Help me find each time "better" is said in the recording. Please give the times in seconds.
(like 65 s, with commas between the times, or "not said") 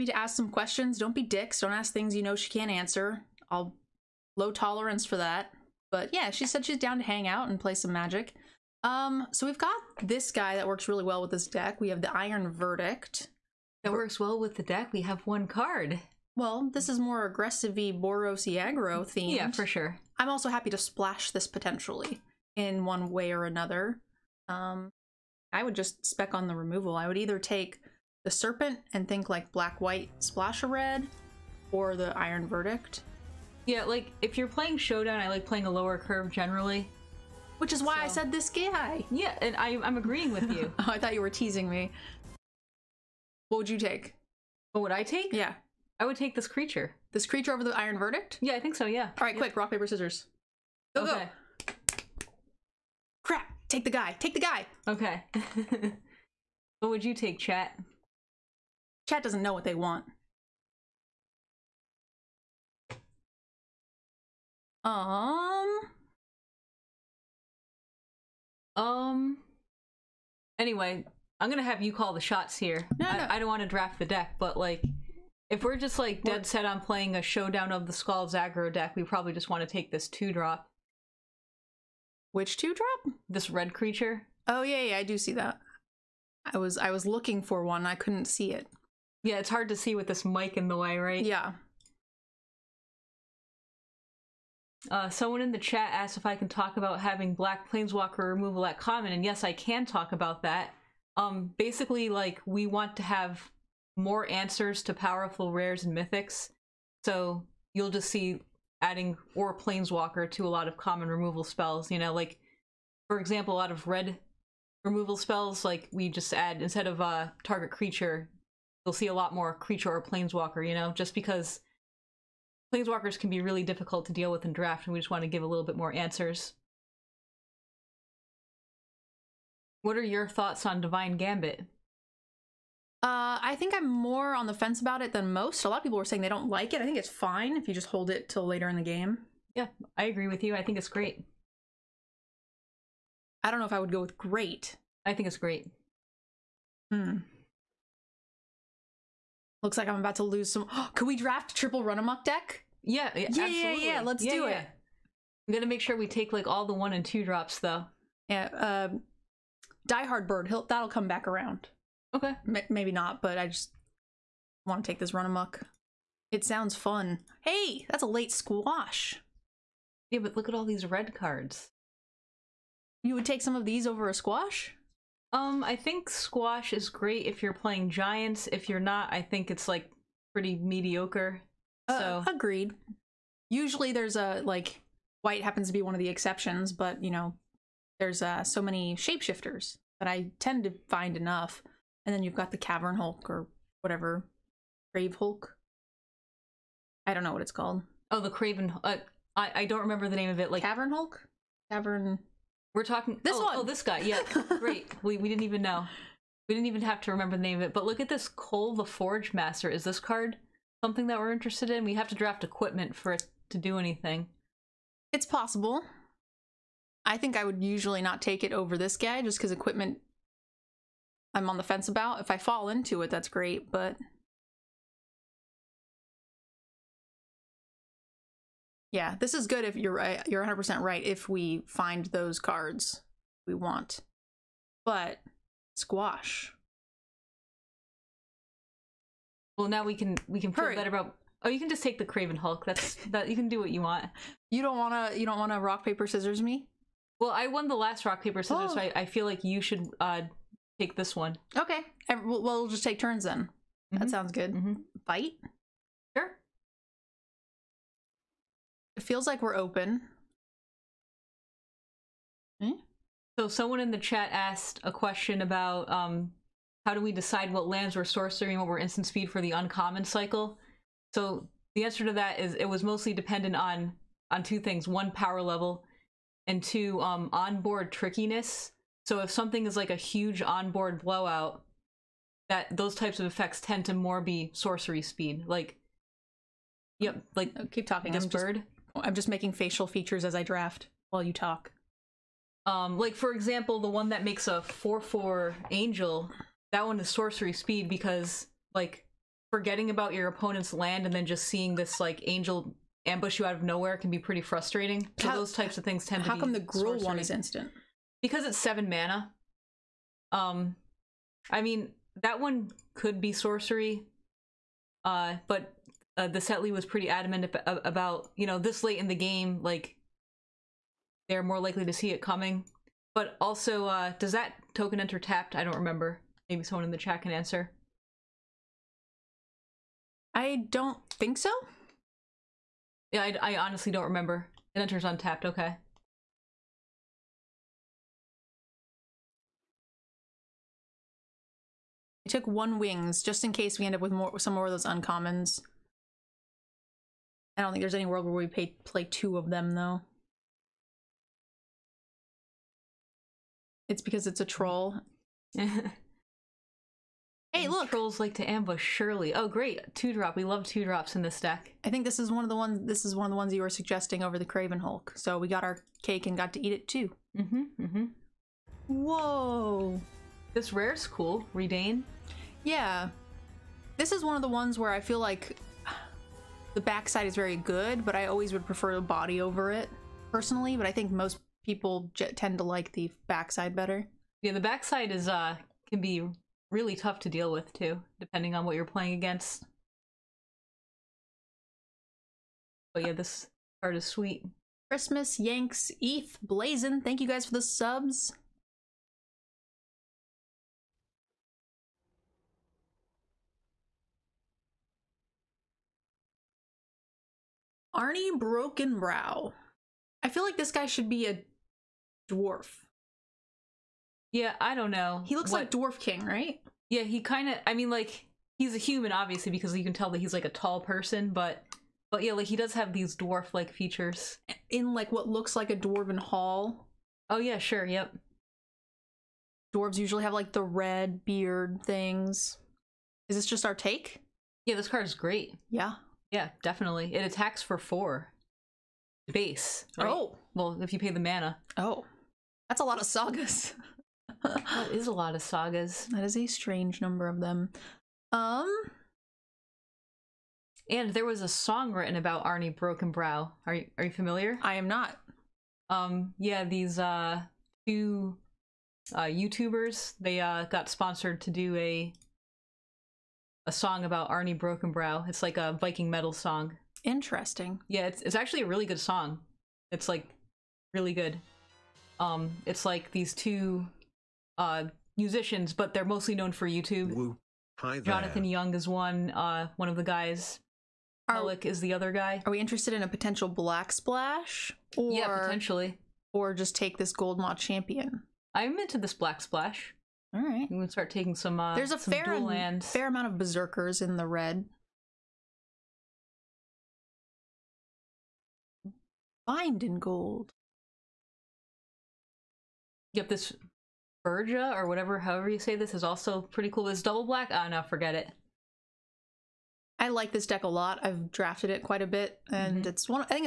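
240 s, 383 s.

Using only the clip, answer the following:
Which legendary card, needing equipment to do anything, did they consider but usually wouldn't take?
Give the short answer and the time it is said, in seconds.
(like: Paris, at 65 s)
Koll the Forgemaster, at 208 s.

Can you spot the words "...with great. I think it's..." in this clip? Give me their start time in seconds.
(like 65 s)
143 s.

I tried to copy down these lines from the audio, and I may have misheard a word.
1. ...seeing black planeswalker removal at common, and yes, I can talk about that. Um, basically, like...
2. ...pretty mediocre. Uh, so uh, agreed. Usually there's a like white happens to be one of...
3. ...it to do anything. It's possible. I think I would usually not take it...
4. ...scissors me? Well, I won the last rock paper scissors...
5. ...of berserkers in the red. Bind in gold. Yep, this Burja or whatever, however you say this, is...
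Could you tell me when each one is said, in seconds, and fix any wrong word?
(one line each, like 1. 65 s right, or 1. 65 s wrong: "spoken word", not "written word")
1. 96 s wrong: "having", not "seeing"
2. 180 s right
3. 213 s right
4. 246 s right
5. 493 s right.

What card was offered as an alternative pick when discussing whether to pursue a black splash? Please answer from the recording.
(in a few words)
Goldmaw Champion.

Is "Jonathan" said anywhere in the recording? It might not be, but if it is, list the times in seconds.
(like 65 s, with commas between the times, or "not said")
478 s.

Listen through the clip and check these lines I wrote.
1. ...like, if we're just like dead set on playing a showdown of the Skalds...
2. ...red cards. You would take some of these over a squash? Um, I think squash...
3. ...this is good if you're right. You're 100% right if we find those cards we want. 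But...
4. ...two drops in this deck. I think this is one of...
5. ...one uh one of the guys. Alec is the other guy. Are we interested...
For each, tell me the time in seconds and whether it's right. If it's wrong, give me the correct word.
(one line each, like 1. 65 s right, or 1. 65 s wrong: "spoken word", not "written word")
1. 74 s right
2. 170 s right
3. 229 s right
4. 360 s right
5. 478 s right.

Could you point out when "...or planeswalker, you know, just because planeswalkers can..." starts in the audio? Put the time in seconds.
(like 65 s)
119 s.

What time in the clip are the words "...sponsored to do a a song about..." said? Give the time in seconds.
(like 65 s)
460 s.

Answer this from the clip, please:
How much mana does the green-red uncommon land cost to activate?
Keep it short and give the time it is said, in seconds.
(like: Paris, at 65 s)
7, at 308 s.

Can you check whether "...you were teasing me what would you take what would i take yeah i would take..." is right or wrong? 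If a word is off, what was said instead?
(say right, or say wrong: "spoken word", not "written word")
right.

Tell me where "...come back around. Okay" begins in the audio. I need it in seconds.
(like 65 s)
160 s.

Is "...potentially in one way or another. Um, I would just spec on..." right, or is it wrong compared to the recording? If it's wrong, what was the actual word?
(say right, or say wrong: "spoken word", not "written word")
right.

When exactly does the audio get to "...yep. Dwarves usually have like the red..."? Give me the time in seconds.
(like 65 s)
427 s.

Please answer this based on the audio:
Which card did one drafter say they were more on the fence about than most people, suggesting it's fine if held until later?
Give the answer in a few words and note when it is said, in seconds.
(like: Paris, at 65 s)
Divine Gambit, at 130 s.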